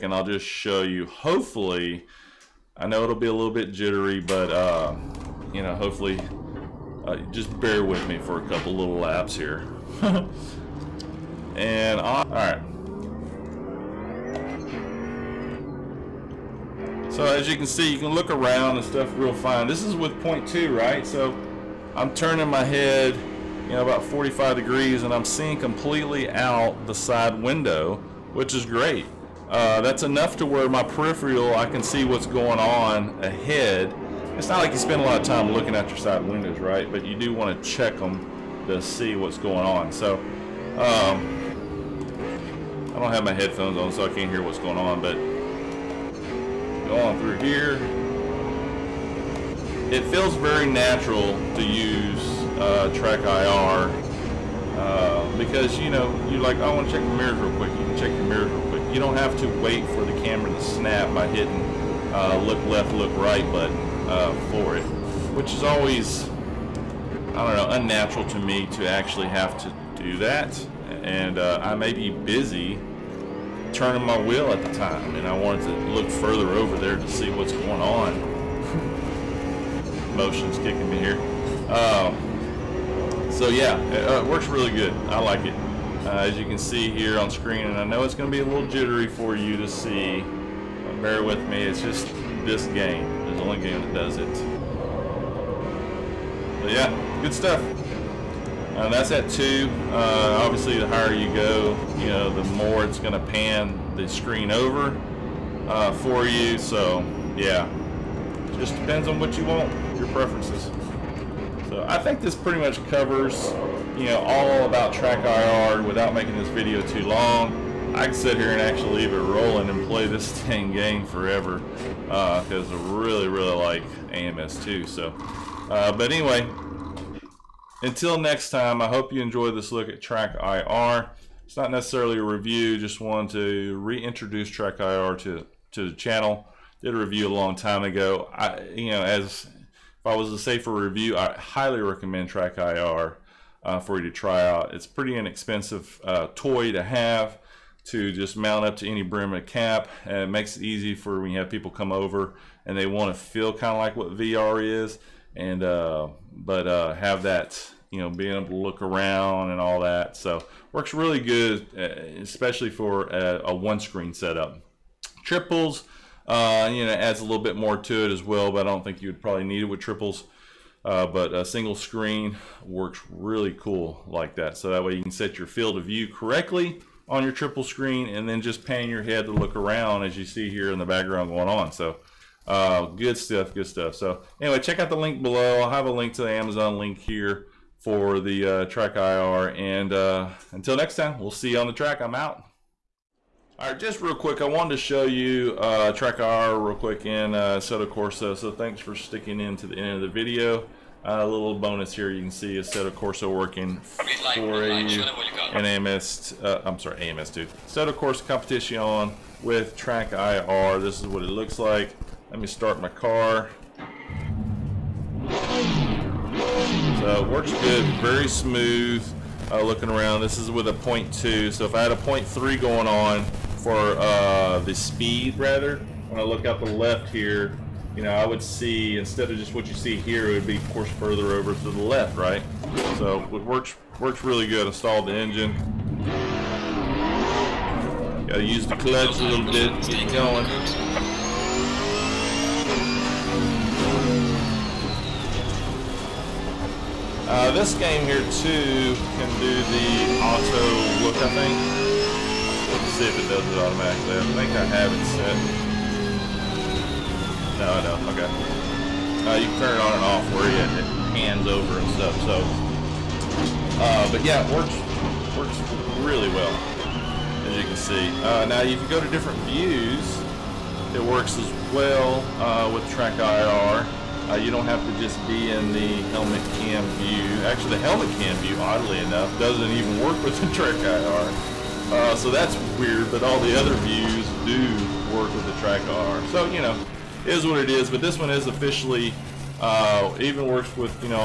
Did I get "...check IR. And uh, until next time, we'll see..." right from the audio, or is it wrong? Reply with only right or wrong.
wrong.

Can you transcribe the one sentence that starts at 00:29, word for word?
Uh, that's enough to where my peripheral, I can see what's going on ahead.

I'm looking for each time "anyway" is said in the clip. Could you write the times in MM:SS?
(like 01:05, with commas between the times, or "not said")
02:06, 03:04.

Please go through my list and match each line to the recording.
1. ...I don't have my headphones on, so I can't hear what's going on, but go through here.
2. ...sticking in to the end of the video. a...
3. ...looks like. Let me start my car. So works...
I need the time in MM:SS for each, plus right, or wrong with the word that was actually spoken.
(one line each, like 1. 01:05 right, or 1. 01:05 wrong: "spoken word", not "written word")
1. 00:42 right
2. 03:18 right
3. 03:31 right.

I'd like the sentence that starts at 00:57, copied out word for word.
You can check your mirrors real quick.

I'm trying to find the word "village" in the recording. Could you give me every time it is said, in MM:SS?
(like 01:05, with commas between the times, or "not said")
not said.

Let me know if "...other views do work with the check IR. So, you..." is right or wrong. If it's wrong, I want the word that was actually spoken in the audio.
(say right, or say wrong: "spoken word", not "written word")
wrong: "track", not "check".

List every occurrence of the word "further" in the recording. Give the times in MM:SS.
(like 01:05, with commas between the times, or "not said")
01:16, 03:50.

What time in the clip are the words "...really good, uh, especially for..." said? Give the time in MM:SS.
02:40.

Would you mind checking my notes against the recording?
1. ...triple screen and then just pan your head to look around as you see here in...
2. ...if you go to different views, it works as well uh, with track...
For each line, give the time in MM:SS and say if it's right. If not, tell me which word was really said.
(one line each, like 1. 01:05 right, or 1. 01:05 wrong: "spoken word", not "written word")
1. 02:57 right
2. 04:28 right.